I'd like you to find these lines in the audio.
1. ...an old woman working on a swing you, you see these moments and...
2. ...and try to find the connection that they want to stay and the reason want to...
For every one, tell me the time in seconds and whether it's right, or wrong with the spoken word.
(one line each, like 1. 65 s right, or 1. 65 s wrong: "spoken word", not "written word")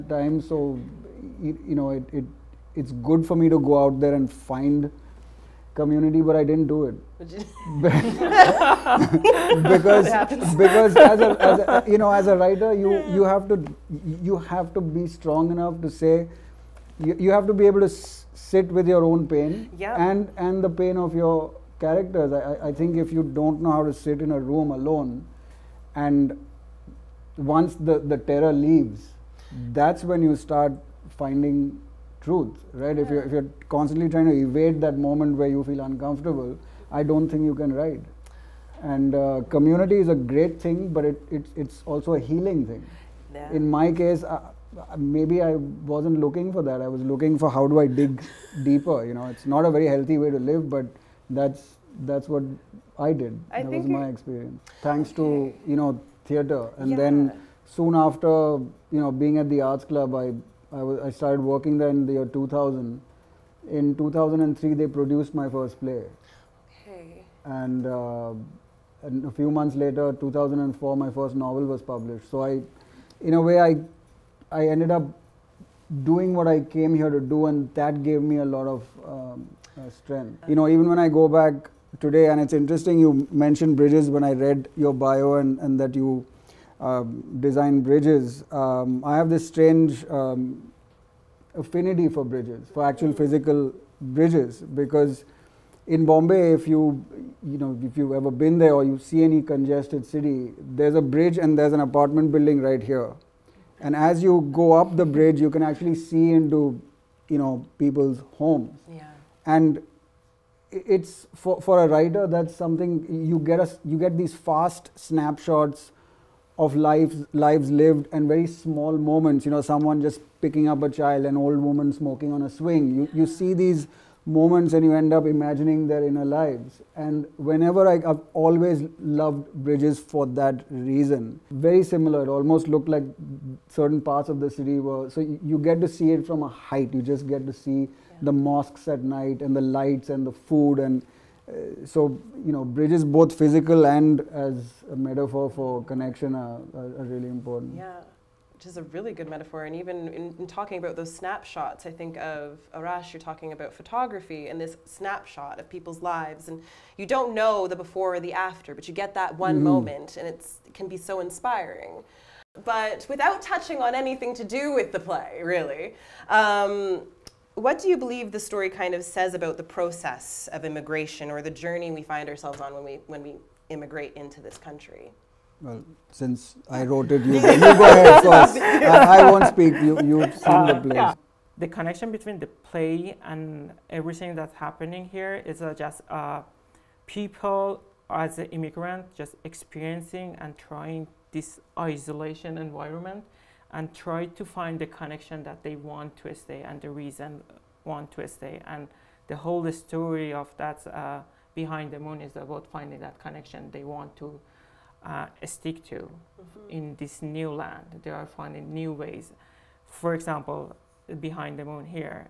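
1. 121 s wrong: "smoking", not "working"
2. 193 s right.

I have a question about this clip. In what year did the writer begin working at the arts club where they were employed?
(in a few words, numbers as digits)
2000.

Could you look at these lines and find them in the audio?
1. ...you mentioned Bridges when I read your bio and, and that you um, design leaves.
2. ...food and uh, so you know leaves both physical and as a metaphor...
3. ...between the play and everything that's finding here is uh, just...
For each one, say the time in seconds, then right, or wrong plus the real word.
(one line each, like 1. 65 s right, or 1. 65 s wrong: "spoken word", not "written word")
1. 82 s wrong: "bridges", not "leaves"
2. 140 s wrong: "bridges", not "leaves"
3. 182 s wrong: "happening", not "finding".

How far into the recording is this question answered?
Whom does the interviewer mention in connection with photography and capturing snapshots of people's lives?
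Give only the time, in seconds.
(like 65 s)
152 s.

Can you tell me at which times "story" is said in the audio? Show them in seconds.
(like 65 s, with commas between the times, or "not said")
168 s, 199 s.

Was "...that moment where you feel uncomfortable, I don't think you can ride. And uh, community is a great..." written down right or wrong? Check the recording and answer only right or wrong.
right.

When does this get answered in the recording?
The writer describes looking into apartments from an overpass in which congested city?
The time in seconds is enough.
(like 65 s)
96 s.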